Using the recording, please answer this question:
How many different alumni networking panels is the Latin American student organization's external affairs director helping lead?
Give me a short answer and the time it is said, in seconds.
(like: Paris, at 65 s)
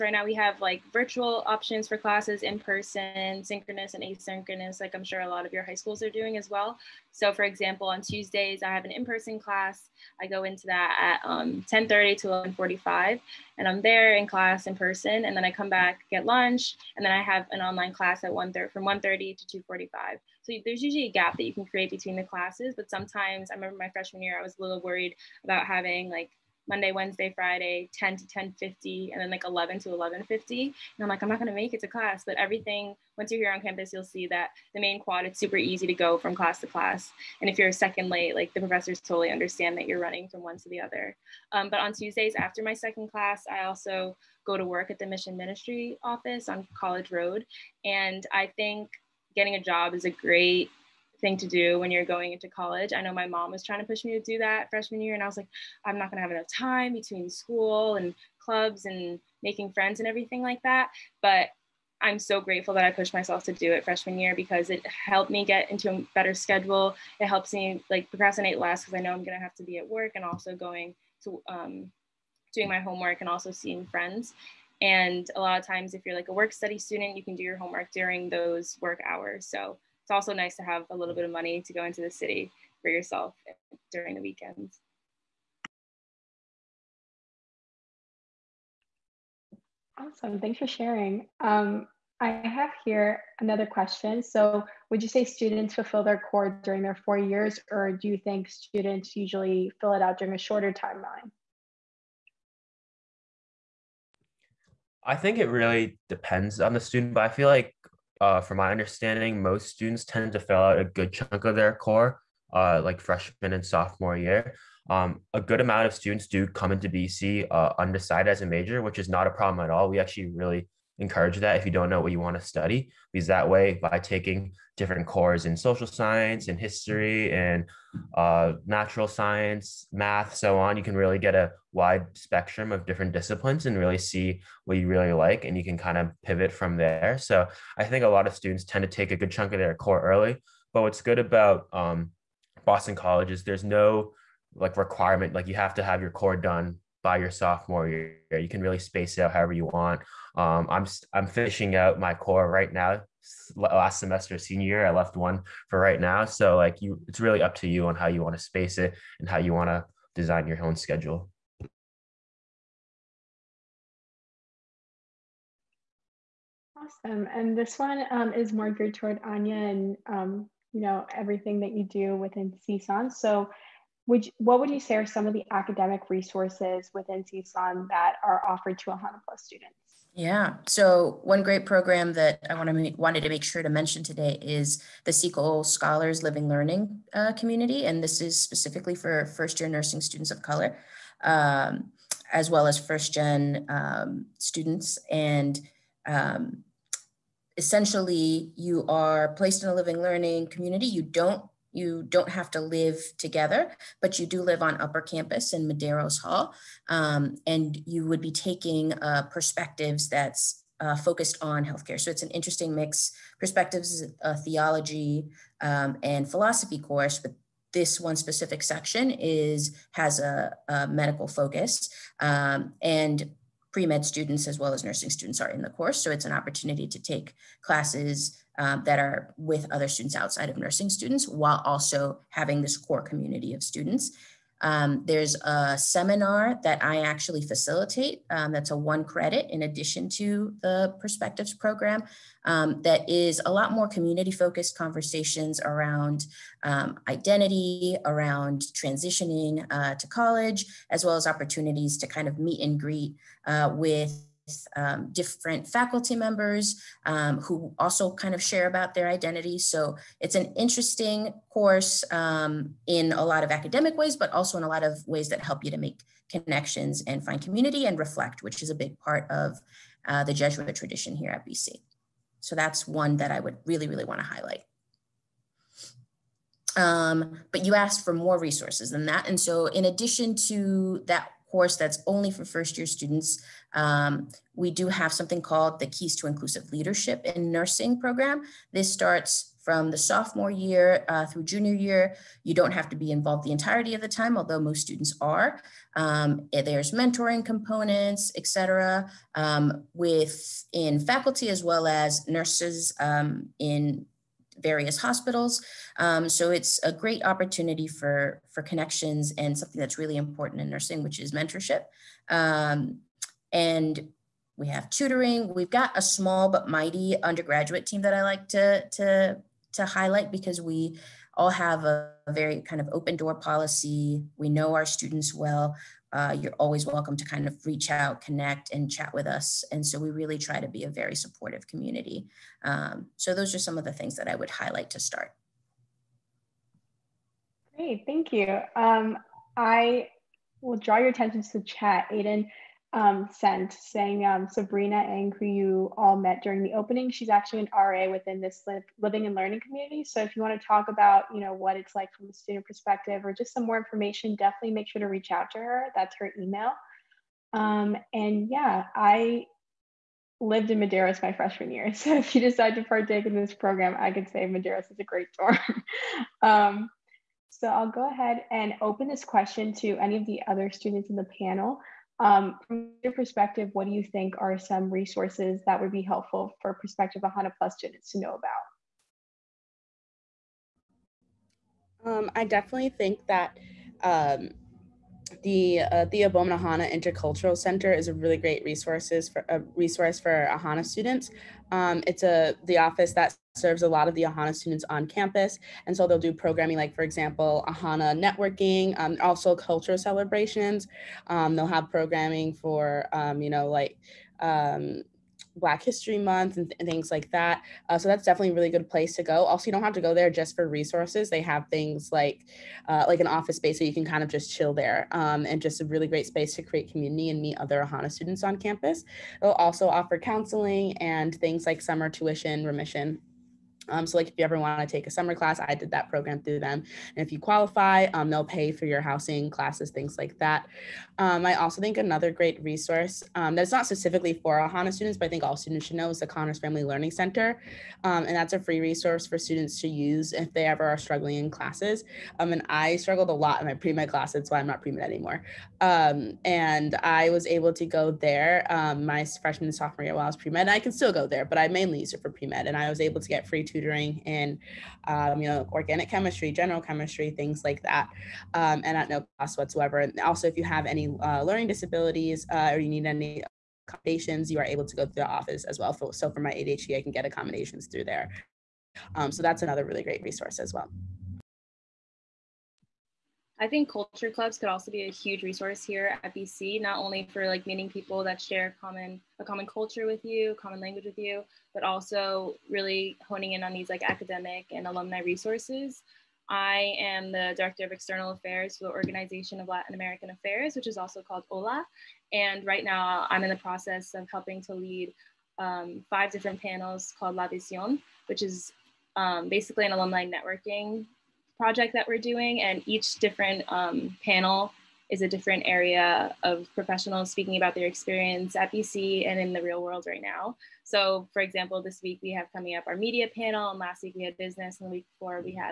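5, at 496 s.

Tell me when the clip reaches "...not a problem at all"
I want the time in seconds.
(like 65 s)
119 s.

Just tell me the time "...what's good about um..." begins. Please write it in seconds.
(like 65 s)
140 s.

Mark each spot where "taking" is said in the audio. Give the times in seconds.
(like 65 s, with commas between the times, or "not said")
123 s, 208 s.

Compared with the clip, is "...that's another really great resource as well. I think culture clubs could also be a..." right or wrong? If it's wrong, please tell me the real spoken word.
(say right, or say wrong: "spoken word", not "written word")
right.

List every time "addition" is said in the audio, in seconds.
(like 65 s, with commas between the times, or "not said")
239 s, 279 s.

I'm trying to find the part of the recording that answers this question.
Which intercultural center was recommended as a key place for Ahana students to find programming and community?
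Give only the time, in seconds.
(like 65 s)
386 s.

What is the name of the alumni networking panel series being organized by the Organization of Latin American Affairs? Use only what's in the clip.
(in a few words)
La Visión.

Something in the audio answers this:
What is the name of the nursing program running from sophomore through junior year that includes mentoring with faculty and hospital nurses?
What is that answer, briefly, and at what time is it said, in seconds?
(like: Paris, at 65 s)
Keys to Inclusive Leadership in Nursing, at 285 s.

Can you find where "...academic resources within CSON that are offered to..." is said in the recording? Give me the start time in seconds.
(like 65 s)
175 s.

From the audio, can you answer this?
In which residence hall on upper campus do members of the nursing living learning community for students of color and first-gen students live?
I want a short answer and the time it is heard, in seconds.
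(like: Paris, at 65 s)
Medeiros Hall, at 205 s.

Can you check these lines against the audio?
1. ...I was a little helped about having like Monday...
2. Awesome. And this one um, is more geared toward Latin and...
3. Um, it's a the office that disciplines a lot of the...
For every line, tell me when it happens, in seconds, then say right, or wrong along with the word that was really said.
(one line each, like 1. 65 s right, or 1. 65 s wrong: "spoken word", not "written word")
1. 24 s wrong: "worried", not "helped"
2. 166 s wrong: "Anya", not "Latin"
3. 391 s wrong: "serves", not "disciplines".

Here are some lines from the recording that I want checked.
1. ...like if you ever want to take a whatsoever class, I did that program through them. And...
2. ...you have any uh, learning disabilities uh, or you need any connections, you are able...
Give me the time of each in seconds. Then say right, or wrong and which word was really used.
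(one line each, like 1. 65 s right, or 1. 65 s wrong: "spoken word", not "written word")
1. 424 s wrong: "summer", not "whatsoever"
2. 460 s wrong: "accommodations", not "connections".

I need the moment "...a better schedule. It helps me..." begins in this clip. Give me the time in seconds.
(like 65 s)
65 s.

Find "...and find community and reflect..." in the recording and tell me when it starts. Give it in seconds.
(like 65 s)
267 s.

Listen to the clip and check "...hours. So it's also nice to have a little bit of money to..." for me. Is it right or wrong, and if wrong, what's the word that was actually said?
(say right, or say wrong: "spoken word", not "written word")
right.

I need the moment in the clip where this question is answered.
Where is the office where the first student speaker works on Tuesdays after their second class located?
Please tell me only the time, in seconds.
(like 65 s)
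46 s.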